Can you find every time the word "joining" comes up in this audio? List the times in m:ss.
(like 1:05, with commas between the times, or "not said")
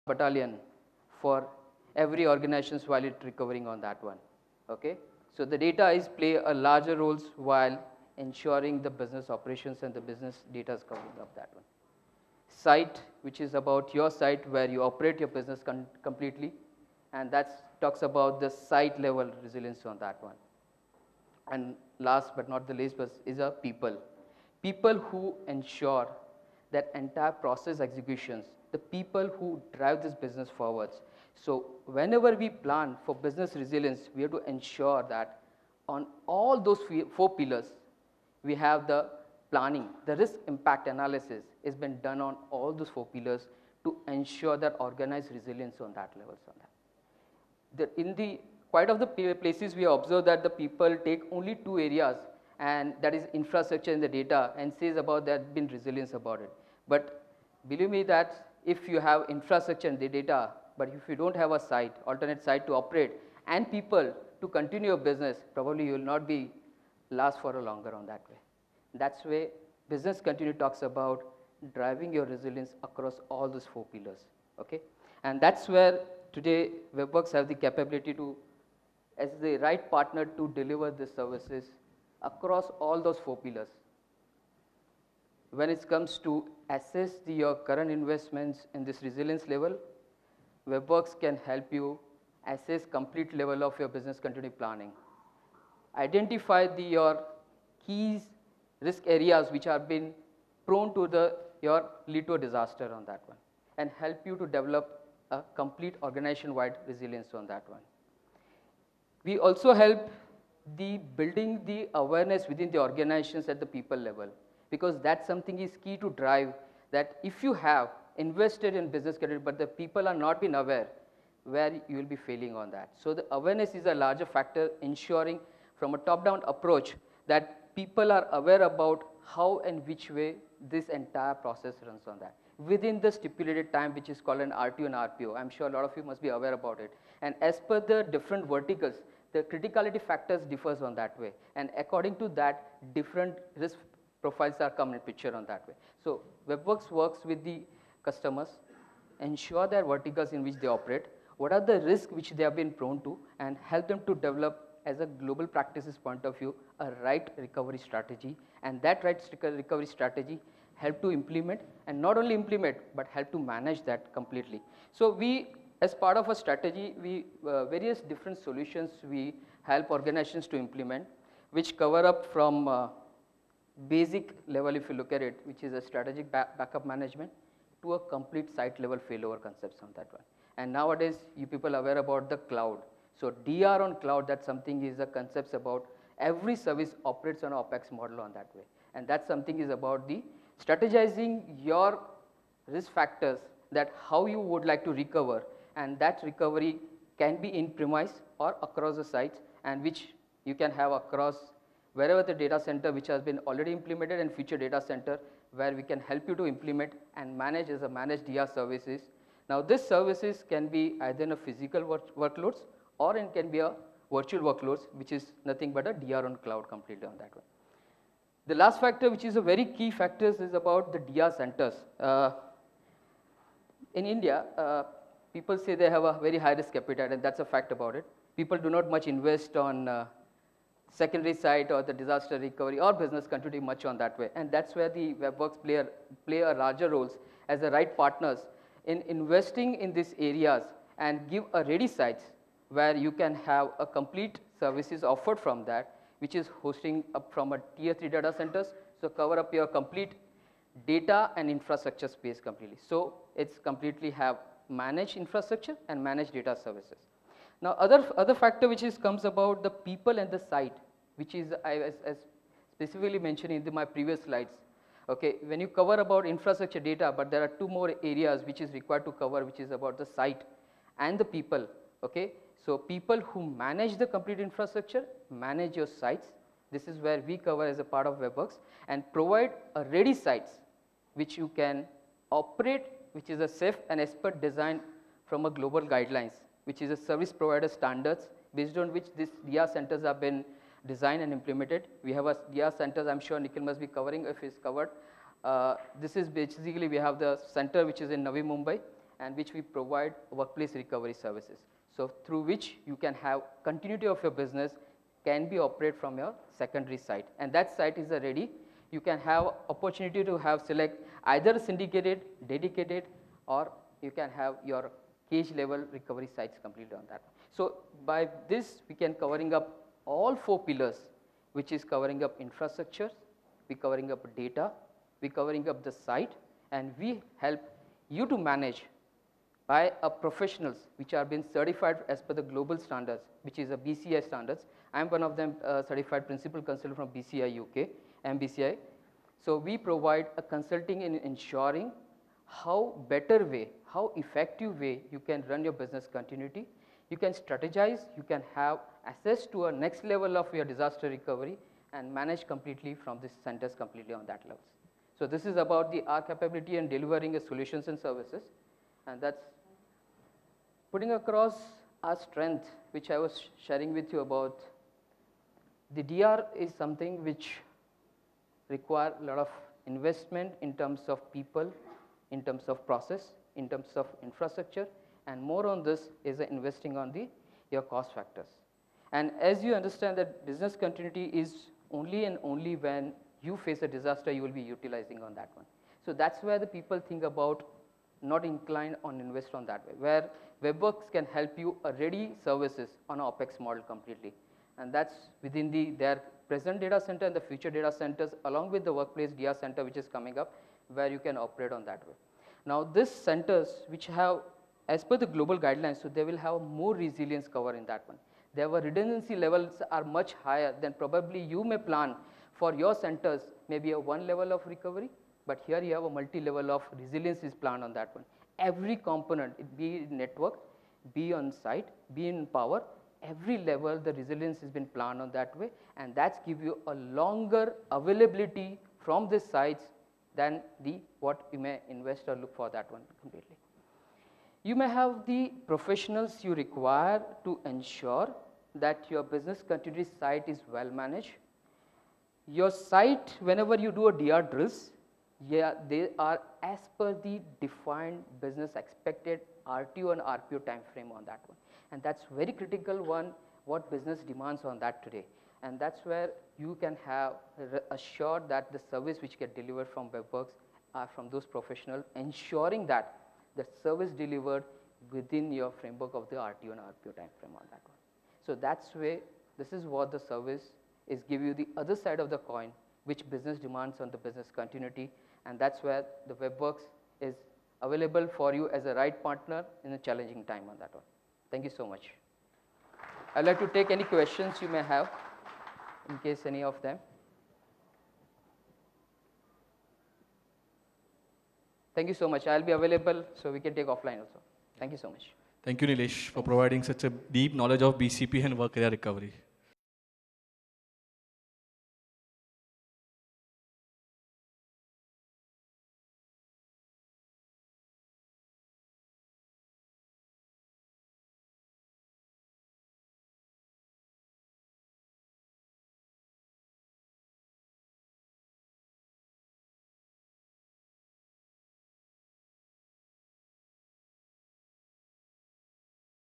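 not said.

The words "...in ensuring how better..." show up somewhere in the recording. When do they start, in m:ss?
5:41.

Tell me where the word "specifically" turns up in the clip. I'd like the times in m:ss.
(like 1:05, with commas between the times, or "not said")
4:22.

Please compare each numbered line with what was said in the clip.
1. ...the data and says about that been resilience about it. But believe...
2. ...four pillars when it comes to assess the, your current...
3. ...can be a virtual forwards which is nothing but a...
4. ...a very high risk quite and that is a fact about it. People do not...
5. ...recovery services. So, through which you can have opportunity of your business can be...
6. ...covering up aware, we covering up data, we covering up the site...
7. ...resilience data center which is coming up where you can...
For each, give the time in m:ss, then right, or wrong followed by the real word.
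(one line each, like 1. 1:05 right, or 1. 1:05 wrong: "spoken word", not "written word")
1. 0:54 right
2. 1:23 right
3. 3:33 wrong: "workloads", not "forwards"
4. 3:46 wrong: "appetite", not "quite"
5. 5:00 wrong: "continuity", not "opportunity"
6. 5:21 wrong: "infrastructure", not "aware"
7. 6:38 wrong: "workplace", not "resilience".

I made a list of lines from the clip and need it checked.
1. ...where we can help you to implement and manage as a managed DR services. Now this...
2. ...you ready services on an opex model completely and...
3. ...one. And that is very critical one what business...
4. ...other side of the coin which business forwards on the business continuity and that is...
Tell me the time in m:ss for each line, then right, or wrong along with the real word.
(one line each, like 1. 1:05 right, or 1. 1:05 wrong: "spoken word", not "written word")
1. 3:25 right
2. 6:31 right
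3. 7:31 right
4. 7:51 wrong: "demands", not "forwards".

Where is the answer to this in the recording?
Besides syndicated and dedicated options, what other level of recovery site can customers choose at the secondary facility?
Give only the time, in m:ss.
5:15.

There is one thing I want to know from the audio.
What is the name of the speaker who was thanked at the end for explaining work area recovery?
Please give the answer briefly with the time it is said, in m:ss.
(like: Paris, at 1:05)
Nilesh, at 8:15.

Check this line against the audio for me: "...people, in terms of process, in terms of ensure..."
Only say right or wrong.
wrong.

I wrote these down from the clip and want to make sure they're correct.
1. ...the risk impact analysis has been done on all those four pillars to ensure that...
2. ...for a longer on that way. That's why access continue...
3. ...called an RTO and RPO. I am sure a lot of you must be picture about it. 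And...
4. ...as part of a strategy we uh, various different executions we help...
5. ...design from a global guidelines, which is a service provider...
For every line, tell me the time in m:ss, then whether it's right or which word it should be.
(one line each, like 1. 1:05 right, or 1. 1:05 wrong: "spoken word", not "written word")
1. 0:40 right
2. 1:07 wrong: "business", not "access"
3. 2:14 wrong: "aware", not "picture"
4. 2:45 wrong: "solutions", not "executions"
5. 4:44 right.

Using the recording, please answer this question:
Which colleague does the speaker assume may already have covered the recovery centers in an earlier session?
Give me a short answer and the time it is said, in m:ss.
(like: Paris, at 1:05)
Nikhil, at 4:53.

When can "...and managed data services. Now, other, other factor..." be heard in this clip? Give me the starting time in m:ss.
4:15.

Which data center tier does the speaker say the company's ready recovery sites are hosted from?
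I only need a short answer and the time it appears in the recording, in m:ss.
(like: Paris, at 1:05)
Tier 3, at 4:07.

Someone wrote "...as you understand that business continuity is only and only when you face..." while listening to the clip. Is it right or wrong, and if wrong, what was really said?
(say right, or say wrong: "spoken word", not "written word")
right.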